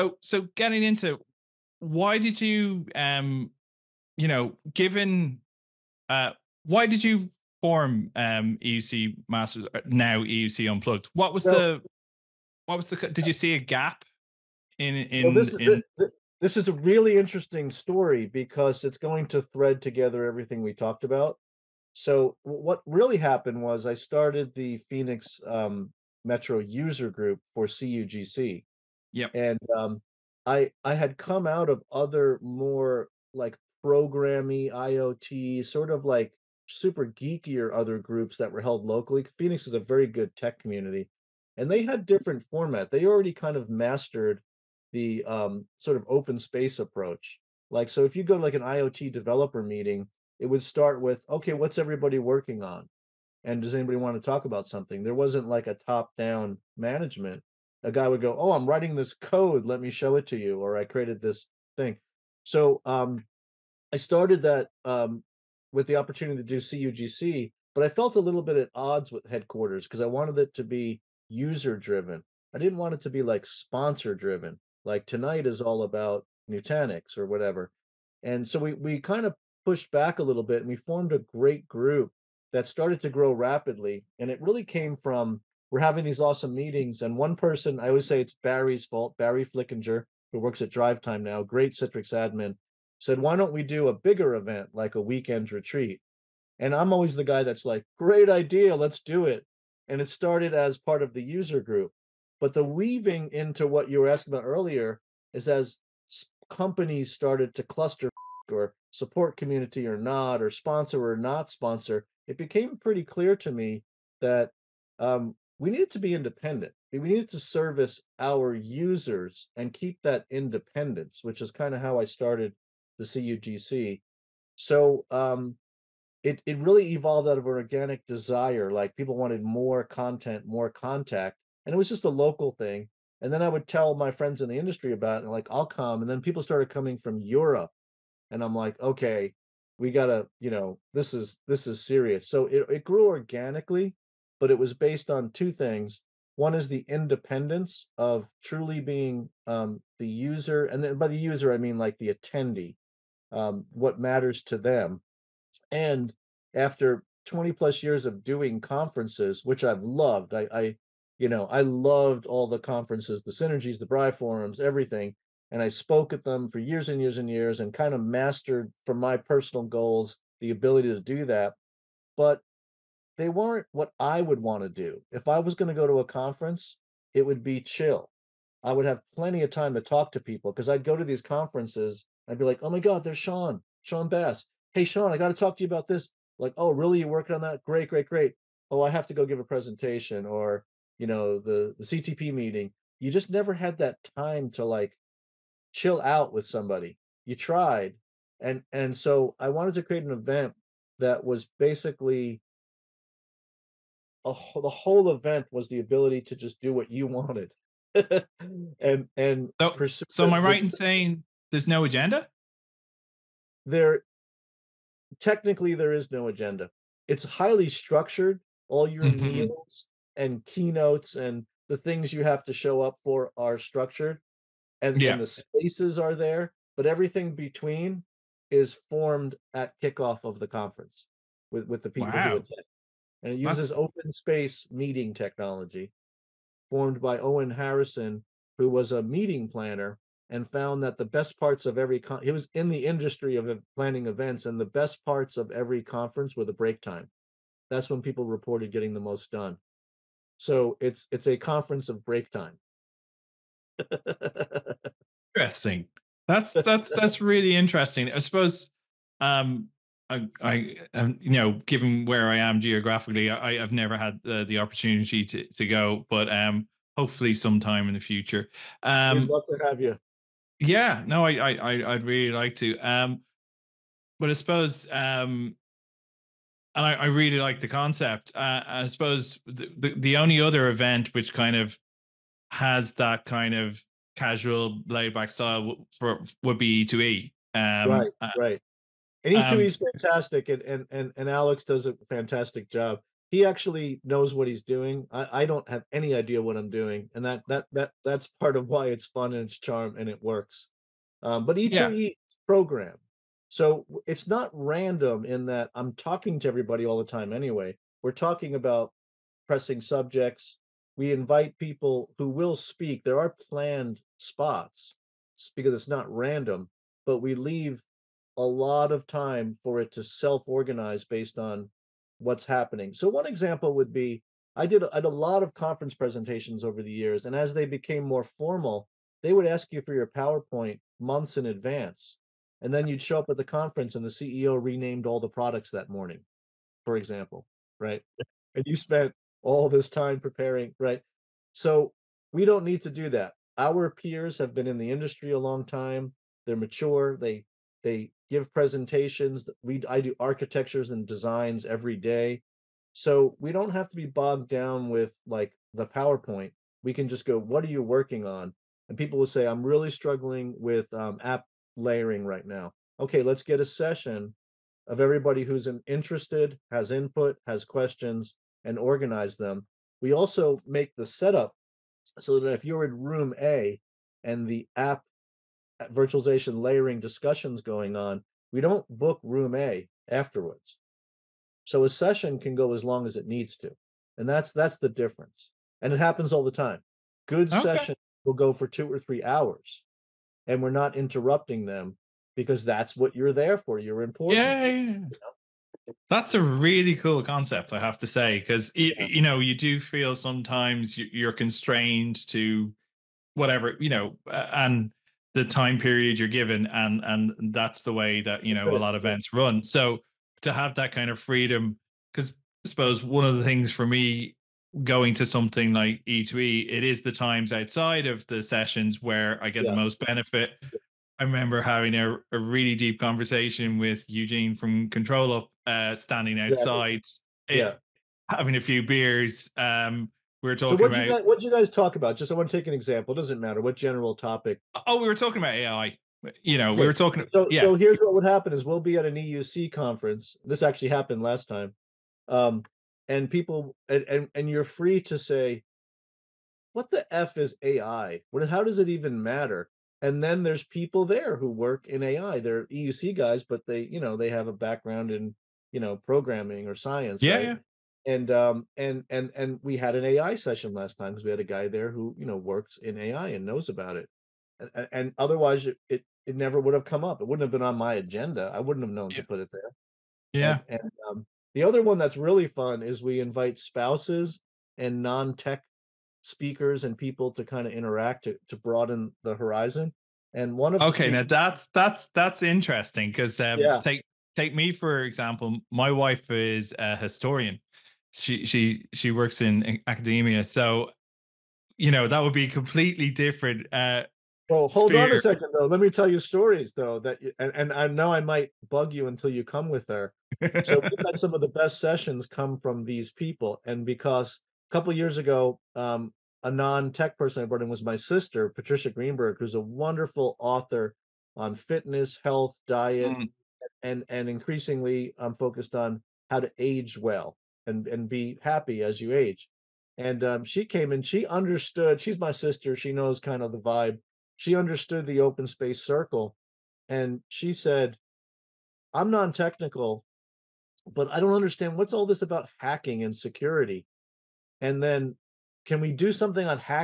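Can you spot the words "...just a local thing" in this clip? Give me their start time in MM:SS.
02:11.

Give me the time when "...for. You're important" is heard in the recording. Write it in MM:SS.
06:33.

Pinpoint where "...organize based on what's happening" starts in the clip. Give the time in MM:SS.
05:20.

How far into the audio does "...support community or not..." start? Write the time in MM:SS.
01:48.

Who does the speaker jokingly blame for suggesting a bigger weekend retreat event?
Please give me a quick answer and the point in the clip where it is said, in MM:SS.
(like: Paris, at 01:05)
Barry Flickinger, at 01:29.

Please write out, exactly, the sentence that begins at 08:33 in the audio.
and and increasingly I'm focused on how to age well and and be happy as you age.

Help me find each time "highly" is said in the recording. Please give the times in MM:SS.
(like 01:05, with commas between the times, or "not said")
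03:37.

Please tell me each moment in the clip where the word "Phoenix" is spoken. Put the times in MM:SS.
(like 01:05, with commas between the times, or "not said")
00:24, 00:39.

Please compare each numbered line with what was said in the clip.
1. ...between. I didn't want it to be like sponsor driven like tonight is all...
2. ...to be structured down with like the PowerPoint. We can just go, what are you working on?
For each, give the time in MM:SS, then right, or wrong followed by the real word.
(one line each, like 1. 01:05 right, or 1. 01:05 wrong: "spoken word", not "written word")
1. 01:11 wrong: "driven", not "between"
2. 05:53 wrong: "bogged", not "structured".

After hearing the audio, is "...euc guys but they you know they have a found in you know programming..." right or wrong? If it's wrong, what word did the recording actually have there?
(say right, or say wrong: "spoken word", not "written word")
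wrong: "background", not "found".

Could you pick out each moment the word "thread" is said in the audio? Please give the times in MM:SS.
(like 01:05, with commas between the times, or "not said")
00:19.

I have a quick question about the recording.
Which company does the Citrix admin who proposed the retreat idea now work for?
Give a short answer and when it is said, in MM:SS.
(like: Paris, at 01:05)
DriveTime, at 01:30.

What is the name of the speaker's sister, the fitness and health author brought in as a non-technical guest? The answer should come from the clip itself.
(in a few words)
Patricia Greenberg.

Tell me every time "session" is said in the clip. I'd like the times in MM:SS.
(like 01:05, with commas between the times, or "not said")
06:03, 06:21, 06:27, 06:58, 07:40, 08:21.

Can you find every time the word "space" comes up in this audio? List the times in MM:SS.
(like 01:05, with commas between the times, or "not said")
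00:46, 03:45, 03:54, 08:45.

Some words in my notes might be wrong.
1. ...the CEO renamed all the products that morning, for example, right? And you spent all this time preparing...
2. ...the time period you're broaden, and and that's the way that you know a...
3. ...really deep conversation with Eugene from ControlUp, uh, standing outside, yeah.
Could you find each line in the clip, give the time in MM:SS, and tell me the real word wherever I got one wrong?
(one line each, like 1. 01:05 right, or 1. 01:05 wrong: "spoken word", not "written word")
1. 05:34 right
2. 06:45 wrong: "given", not "broaden"
3. 07:02 right.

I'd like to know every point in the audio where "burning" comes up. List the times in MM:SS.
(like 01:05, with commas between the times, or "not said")
not said.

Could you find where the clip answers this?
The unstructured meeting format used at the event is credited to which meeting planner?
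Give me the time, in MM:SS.
03:57.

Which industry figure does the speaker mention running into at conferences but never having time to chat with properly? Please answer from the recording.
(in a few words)
Shawn Bass.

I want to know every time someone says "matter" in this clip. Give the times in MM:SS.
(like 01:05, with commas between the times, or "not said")
02:33, 07:13, 07:29.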